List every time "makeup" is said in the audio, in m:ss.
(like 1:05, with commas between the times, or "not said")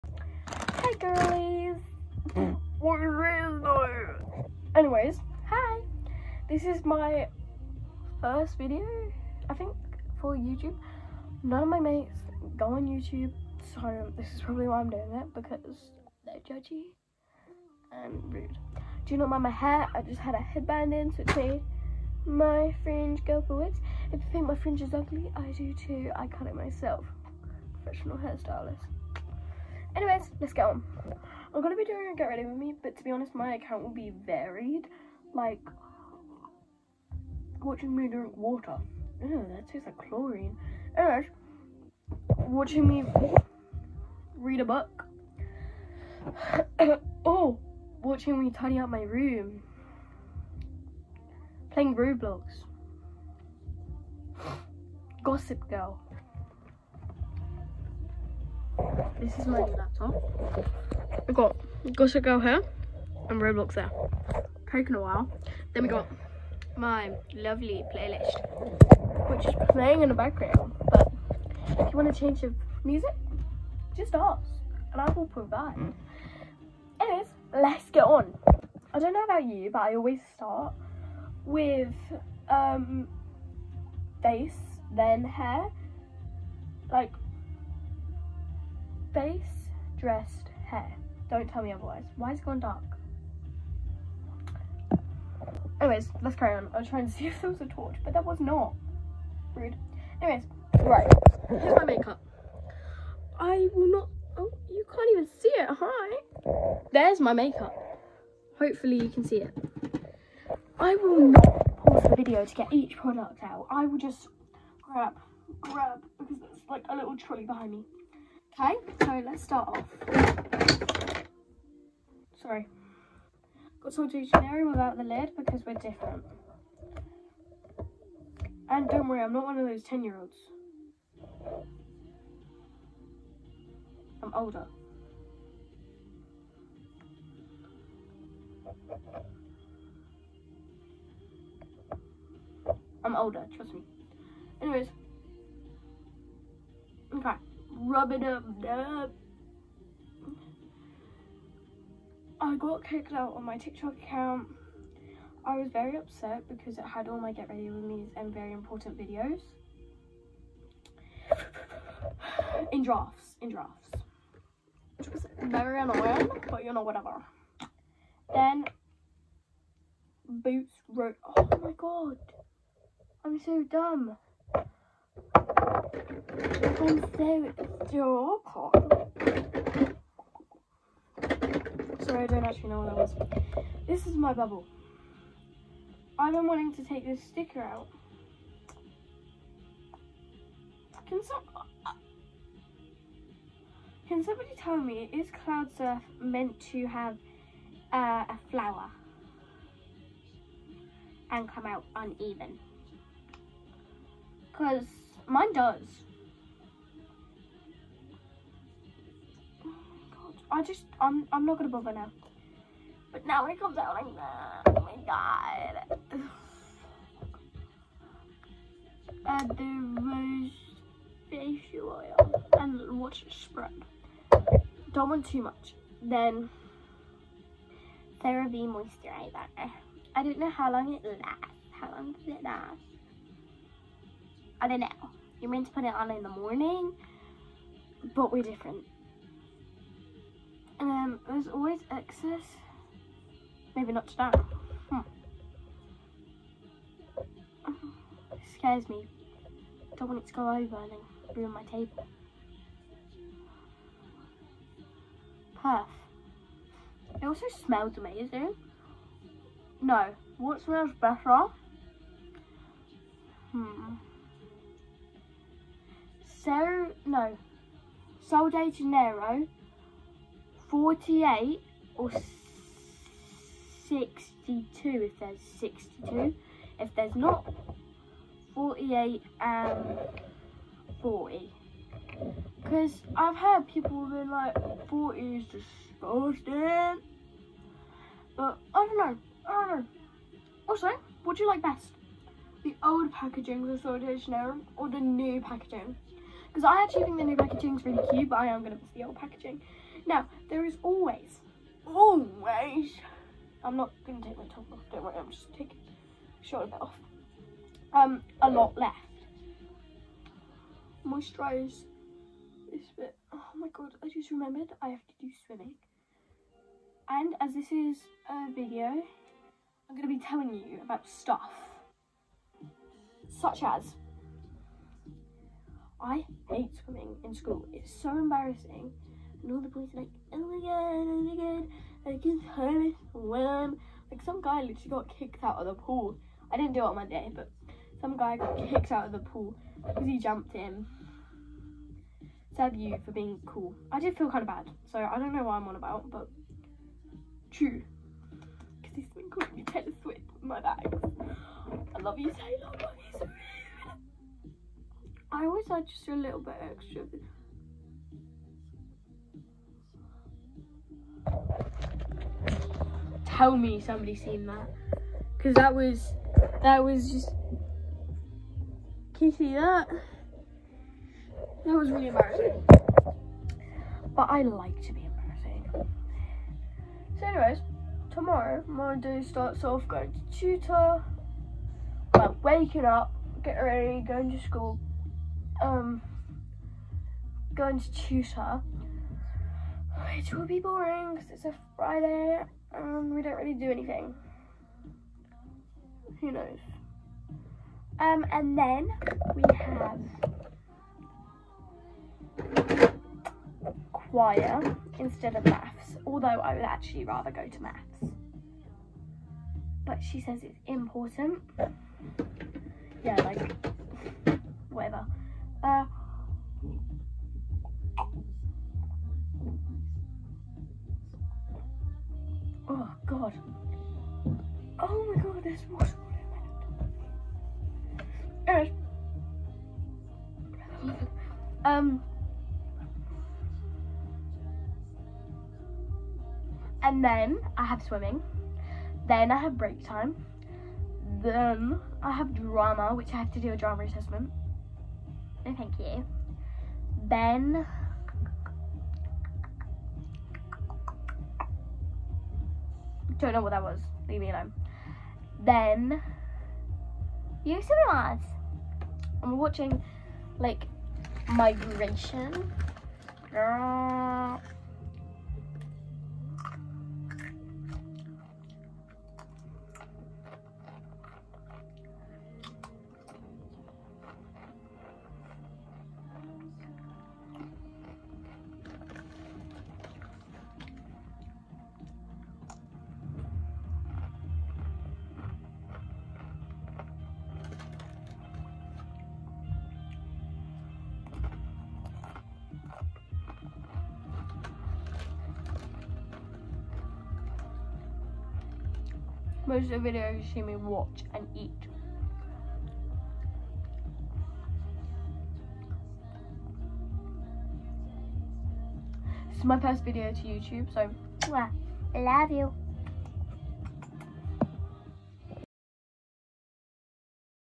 1:41, 1:47.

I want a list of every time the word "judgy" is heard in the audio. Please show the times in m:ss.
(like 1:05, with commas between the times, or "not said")
0:16.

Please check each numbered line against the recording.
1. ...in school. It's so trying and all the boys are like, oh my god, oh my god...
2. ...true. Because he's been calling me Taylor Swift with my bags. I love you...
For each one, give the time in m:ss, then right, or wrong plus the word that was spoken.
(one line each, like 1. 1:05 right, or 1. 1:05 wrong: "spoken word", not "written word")
1. 5:27 wrong: "embarrassing", not "trying"
2. 5:47 right.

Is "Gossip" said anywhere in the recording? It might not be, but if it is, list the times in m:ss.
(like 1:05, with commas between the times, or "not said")
0:55, 1:01.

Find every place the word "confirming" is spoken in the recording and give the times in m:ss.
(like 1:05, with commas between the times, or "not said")
not said.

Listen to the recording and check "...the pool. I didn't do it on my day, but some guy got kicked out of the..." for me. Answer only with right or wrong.
right.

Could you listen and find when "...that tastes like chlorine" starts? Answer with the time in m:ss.
0:39.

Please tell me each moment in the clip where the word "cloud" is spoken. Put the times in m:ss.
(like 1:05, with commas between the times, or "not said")
3:15.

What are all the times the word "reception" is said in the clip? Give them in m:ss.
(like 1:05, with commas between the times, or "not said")
not said.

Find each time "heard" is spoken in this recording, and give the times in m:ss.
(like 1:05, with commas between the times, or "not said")
4:43, 5:32.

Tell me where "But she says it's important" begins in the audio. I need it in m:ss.
6:49.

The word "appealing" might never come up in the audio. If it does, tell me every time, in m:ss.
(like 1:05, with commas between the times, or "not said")
not said.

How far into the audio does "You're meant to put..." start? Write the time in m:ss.
3:55.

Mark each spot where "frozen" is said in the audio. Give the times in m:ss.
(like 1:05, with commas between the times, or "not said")
not said.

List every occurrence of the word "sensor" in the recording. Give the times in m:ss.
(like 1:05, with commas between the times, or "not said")
not said.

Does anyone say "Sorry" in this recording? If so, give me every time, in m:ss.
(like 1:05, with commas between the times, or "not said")
2:02, 3:01.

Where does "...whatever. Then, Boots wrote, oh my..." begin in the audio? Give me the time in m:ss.
2:46.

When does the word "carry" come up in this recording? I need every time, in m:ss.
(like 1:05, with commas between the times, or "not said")
1:36.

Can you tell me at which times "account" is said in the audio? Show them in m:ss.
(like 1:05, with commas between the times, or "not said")
0:33, 2:34.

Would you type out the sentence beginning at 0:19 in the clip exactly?
I just had a headband in, so it made my fringe go forwards.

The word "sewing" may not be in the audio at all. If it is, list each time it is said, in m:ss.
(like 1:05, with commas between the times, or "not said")
not said.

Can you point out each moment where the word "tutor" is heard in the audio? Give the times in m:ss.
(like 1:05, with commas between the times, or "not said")
6:20, 6:27.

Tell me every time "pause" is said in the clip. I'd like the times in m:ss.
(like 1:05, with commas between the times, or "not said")
1:51.